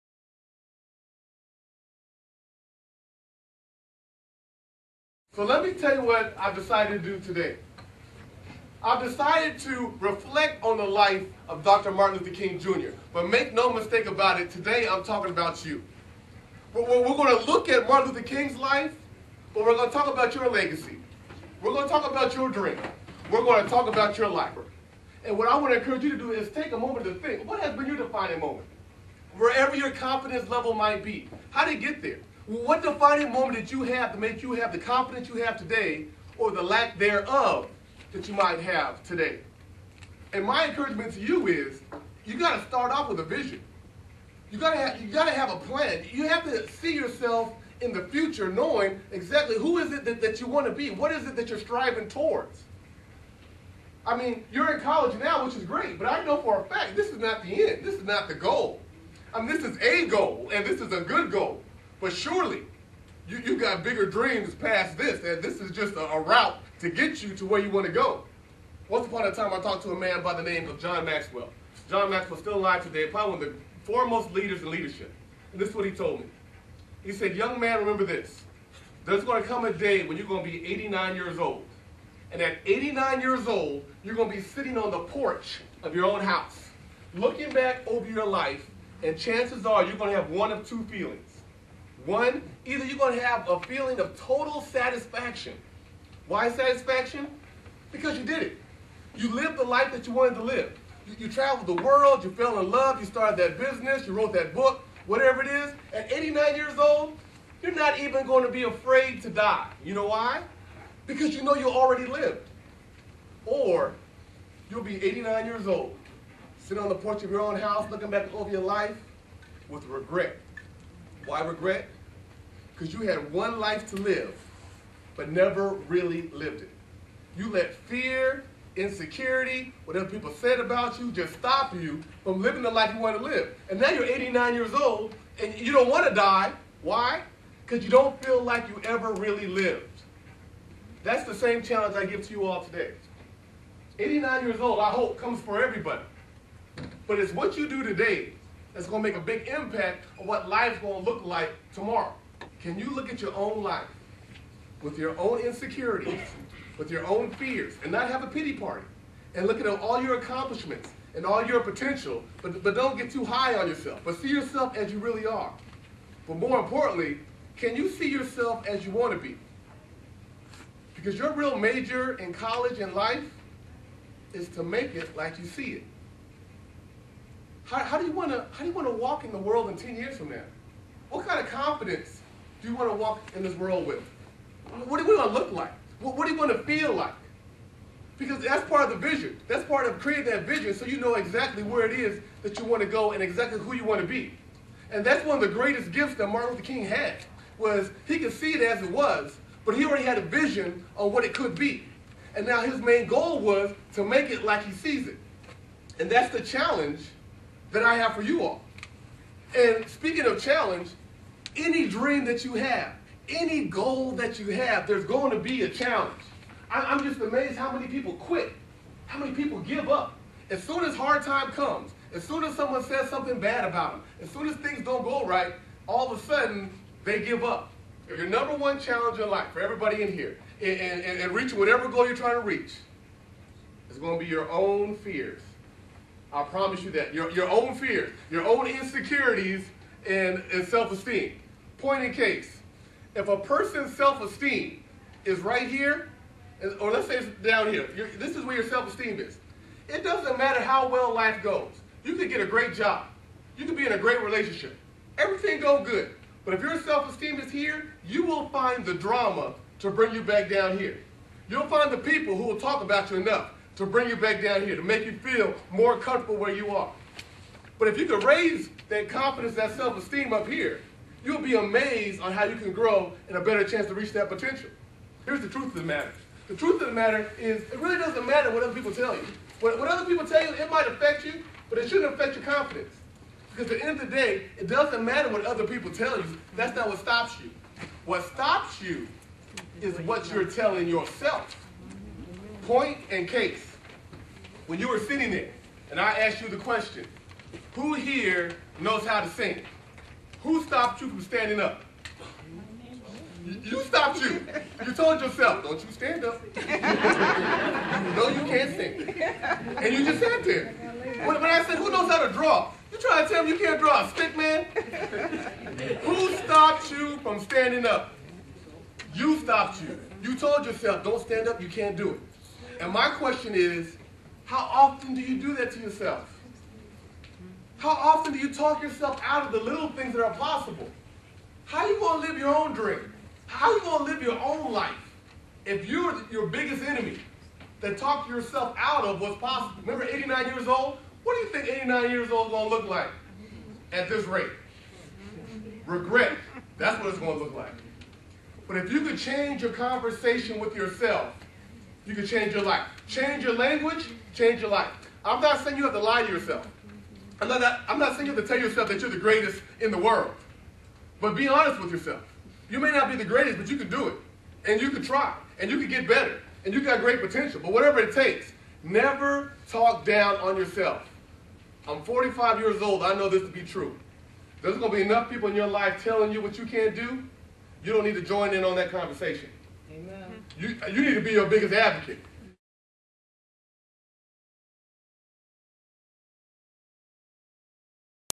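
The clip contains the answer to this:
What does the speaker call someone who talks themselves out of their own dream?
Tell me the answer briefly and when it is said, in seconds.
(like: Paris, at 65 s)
biggest enemy, at 336 s.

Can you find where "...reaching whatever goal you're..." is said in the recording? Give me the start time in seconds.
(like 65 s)
231 s.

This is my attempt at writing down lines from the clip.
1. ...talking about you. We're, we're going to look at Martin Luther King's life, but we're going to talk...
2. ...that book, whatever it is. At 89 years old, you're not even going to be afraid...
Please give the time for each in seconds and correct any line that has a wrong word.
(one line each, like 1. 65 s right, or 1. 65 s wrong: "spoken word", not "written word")
1. 15 s right
2. 104 s right.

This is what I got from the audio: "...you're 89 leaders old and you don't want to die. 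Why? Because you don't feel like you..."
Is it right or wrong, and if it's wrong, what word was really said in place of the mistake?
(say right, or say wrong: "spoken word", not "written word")
wrong: "years", not "leaders".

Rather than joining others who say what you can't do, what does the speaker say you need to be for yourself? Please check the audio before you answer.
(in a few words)
biggest advocate.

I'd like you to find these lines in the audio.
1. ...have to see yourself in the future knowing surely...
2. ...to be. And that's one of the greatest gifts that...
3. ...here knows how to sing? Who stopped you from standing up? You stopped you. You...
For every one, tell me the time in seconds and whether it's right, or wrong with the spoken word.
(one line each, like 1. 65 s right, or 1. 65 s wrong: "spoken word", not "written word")
1. 46 s wrong: "exactly", not "surely"
2. 194 s right
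3. 297 s right.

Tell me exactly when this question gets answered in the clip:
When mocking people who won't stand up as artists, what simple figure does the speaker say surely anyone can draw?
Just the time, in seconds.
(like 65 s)
314 s.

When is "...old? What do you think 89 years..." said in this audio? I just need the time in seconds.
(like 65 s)
340 s.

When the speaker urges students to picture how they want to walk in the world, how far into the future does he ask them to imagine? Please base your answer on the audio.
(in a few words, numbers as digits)
10 years.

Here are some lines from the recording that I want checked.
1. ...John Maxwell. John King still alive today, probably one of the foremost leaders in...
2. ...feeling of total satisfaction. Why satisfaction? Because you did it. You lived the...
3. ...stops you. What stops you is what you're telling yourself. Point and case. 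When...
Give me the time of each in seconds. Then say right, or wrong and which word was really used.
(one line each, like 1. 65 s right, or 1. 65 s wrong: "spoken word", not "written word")
1. 70 s wrong: "Maxwell", not "King"
2. 93 s right
3. 286 s right.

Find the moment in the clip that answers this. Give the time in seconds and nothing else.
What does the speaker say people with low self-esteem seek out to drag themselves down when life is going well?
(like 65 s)
258 s.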